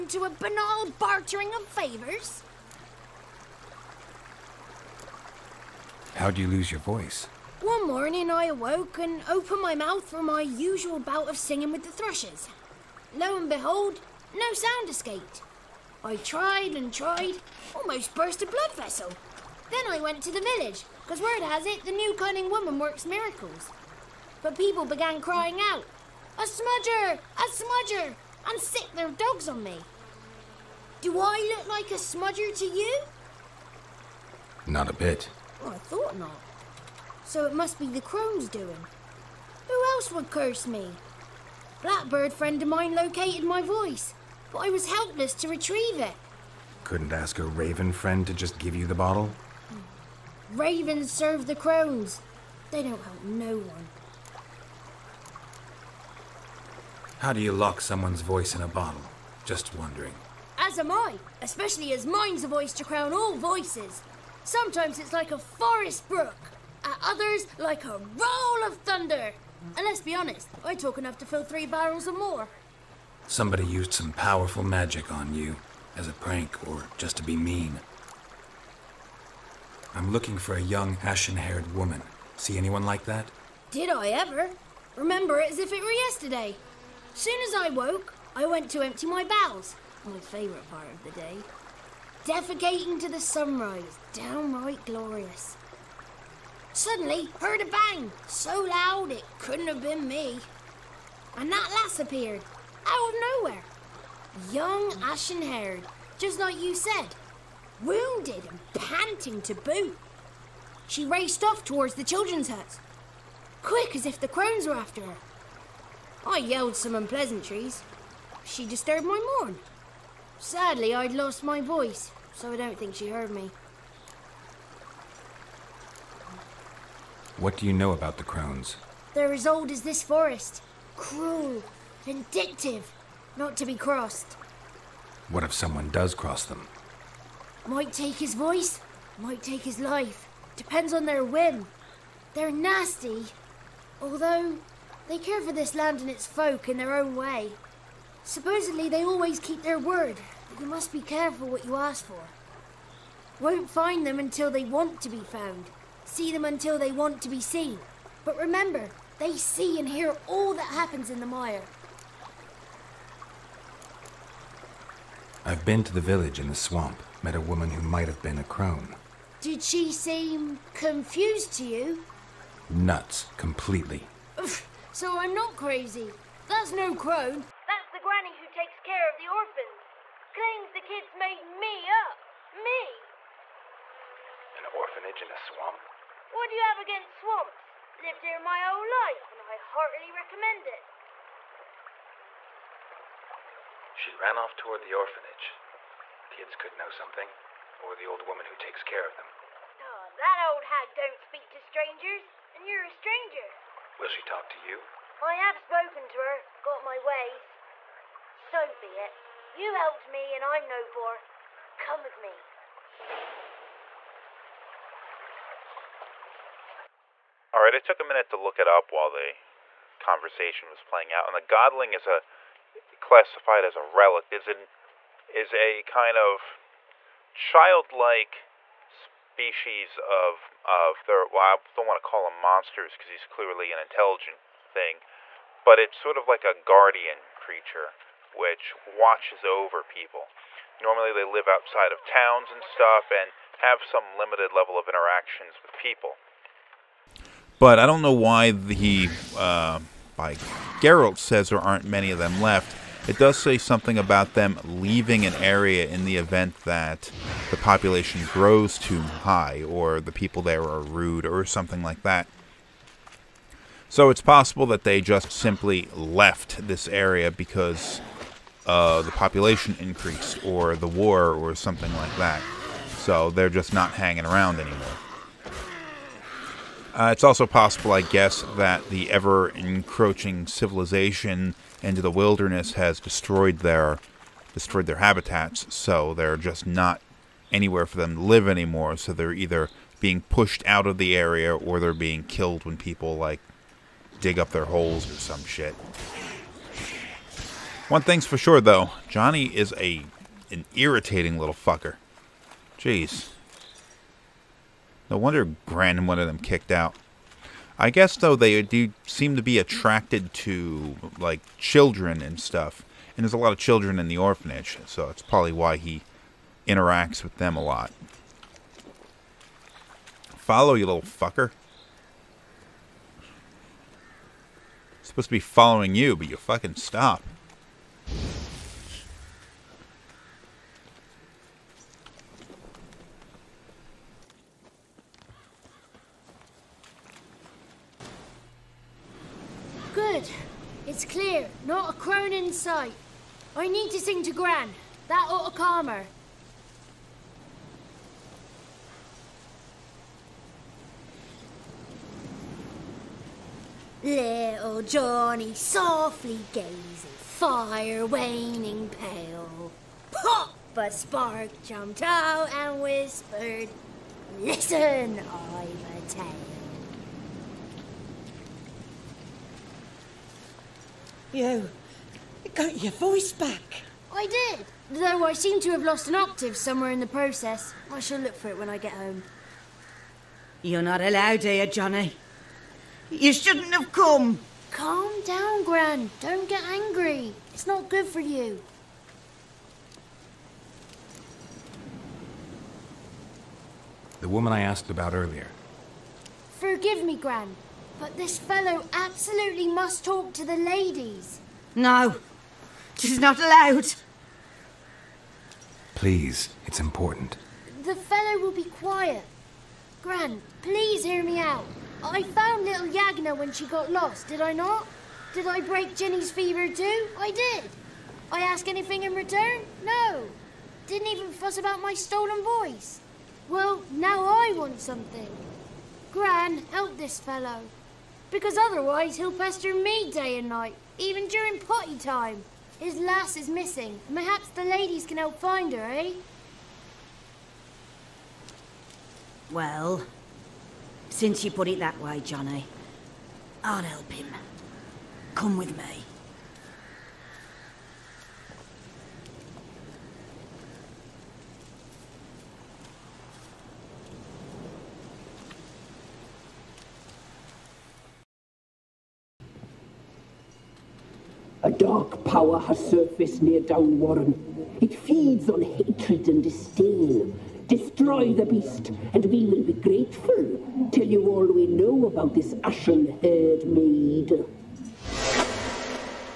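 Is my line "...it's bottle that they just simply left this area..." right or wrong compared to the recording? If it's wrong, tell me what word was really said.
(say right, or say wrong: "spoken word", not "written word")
wrong: "possible", not "bottle".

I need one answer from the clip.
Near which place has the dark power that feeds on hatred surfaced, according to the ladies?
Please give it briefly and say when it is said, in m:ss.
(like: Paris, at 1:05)
Downwarren, at 7:43.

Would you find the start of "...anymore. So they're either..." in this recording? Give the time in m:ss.
4:48.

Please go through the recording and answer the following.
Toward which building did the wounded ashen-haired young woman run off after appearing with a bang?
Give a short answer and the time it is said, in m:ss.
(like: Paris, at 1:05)
The children's hut, at 1:52.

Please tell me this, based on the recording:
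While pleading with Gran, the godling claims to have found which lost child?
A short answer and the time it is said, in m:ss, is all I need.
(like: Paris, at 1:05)
Yagna, at 6:52.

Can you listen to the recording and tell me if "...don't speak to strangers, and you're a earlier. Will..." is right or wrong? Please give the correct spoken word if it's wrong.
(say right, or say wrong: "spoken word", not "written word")
wrong: "stranger", not "earlier".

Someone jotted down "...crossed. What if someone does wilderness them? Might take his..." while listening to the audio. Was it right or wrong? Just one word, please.
wrong.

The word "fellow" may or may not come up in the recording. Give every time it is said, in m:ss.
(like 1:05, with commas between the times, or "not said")
6:38, 6:47, 7:07.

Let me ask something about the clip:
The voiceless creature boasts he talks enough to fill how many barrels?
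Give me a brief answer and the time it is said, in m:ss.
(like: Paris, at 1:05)
3, at 1:11.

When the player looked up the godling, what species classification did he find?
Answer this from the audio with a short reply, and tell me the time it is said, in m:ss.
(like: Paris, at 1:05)
Relic, at 3:43.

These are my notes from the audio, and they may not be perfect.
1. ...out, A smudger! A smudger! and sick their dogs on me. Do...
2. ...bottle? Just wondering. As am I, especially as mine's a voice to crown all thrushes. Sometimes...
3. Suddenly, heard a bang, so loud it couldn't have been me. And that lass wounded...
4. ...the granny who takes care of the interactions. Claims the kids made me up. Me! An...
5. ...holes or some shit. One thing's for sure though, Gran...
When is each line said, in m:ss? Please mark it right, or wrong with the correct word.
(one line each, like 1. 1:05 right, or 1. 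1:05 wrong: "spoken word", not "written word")
1. 0:25 right
2. 0:58 wrong: "voices", not "thrushes"
3. 1:36 wrong: "appeared", not "wounded"
4. 2:57 wrong: "orphans", not "interactions"
5. 4:54 wrong: "Johnny", not "Gran".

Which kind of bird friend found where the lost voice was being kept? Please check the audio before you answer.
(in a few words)
Blackbird.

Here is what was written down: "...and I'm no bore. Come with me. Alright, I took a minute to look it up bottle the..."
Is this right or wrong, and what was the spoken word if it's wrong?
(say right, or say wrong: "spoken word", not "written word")
wrong: "while", not "bottle".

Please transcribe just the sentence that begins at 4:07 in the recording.
But I don't know why he, uh, by Geralt says there aren't many of them left.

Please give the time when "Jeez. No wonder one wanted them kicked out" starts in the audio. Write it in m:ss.
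5:02.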